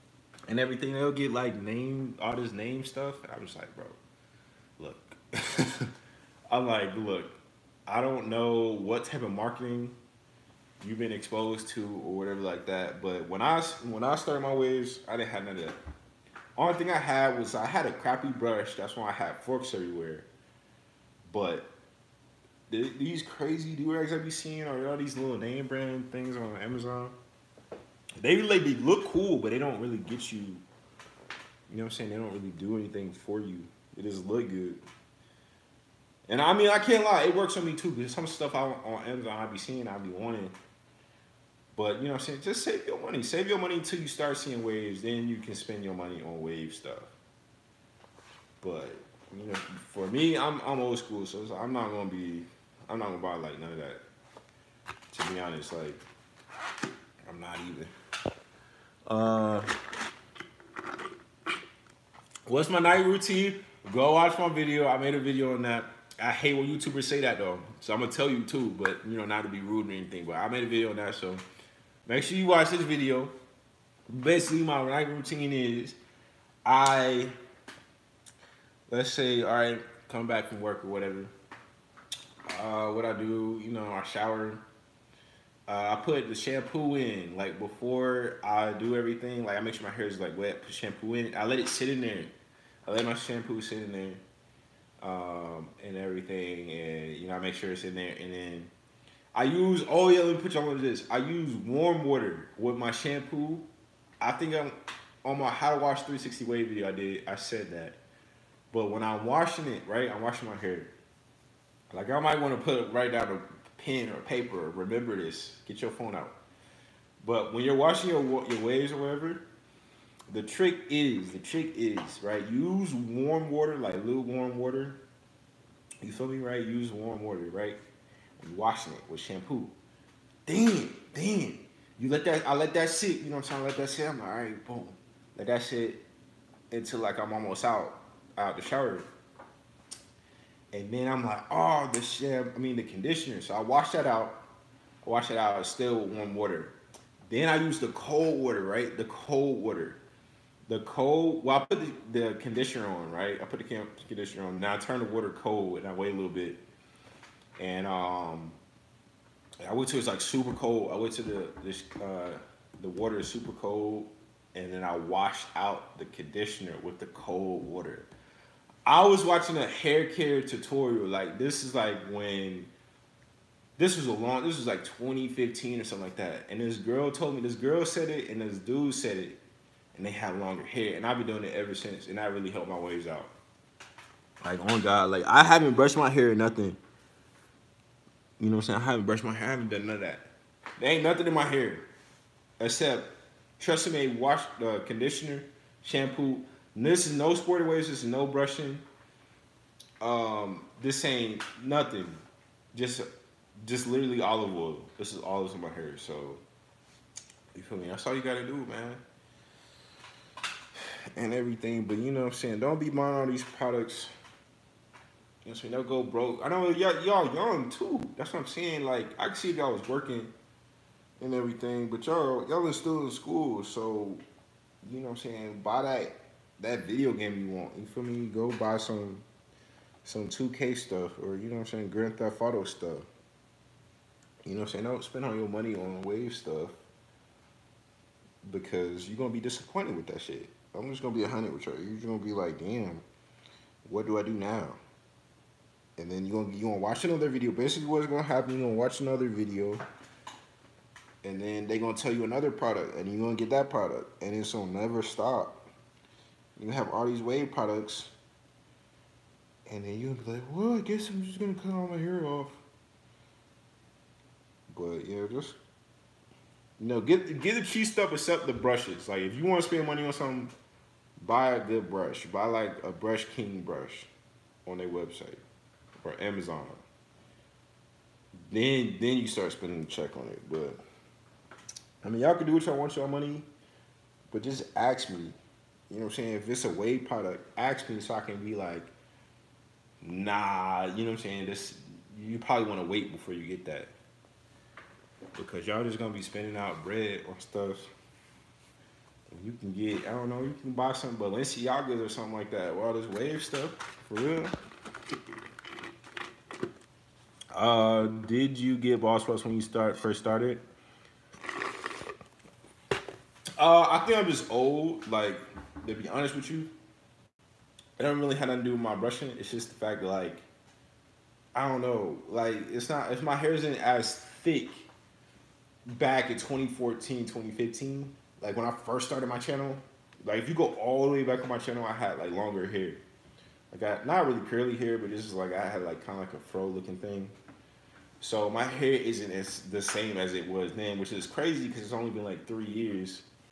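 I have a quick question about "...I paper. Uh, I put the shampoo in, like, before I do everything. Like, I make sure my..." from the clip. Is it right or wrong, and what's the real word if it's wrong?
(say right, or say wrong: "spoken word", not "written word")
wrong: "shower", not "paper".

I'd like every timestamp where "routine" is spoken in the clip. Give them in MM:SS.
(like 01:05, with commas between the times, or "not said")
01:03, 01:15.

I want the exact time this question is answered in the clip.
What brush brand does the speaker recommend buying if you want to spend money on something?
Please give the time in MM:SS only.
04:32.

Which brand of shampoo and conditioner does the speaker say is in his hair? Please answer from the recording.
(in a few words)
Tresemme.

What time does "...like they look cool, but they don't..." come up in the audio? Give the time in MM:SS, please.
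00:28.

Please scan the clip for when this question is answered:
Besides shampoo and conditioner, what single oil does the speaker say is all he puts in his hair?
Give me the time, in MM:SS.
03:24.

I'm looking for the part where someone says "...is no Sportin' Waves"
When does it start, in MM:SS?
03:17.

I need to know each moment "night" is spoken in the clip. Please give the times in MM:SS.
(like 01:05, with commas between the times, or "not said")
01:02, 01:14.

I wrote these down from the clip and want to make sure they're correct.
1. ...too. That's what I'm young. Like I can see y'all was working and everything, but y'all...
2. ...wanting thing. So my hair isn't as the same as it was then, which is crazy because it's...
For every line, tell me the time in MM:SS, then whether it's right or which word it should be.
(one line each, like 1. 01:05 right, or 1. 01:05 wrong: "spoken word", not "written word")
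1. 03:37 wrong: "saying", not "young"
2. 05:36 wrong: "looking", not "wanting".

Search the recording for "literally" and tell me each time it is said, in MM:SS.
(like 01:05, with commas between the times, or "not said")
03:23.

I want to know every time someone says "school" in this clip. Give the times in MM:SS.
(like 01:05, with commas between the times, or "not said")
00:50, 03:43.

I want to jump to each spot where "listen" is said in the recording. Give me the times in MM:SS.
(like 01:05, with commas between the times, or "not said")
not said.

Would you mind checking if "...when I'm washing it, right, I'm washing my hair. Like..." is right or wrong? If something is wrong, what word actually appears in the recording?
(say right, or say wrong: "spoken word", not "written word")
right.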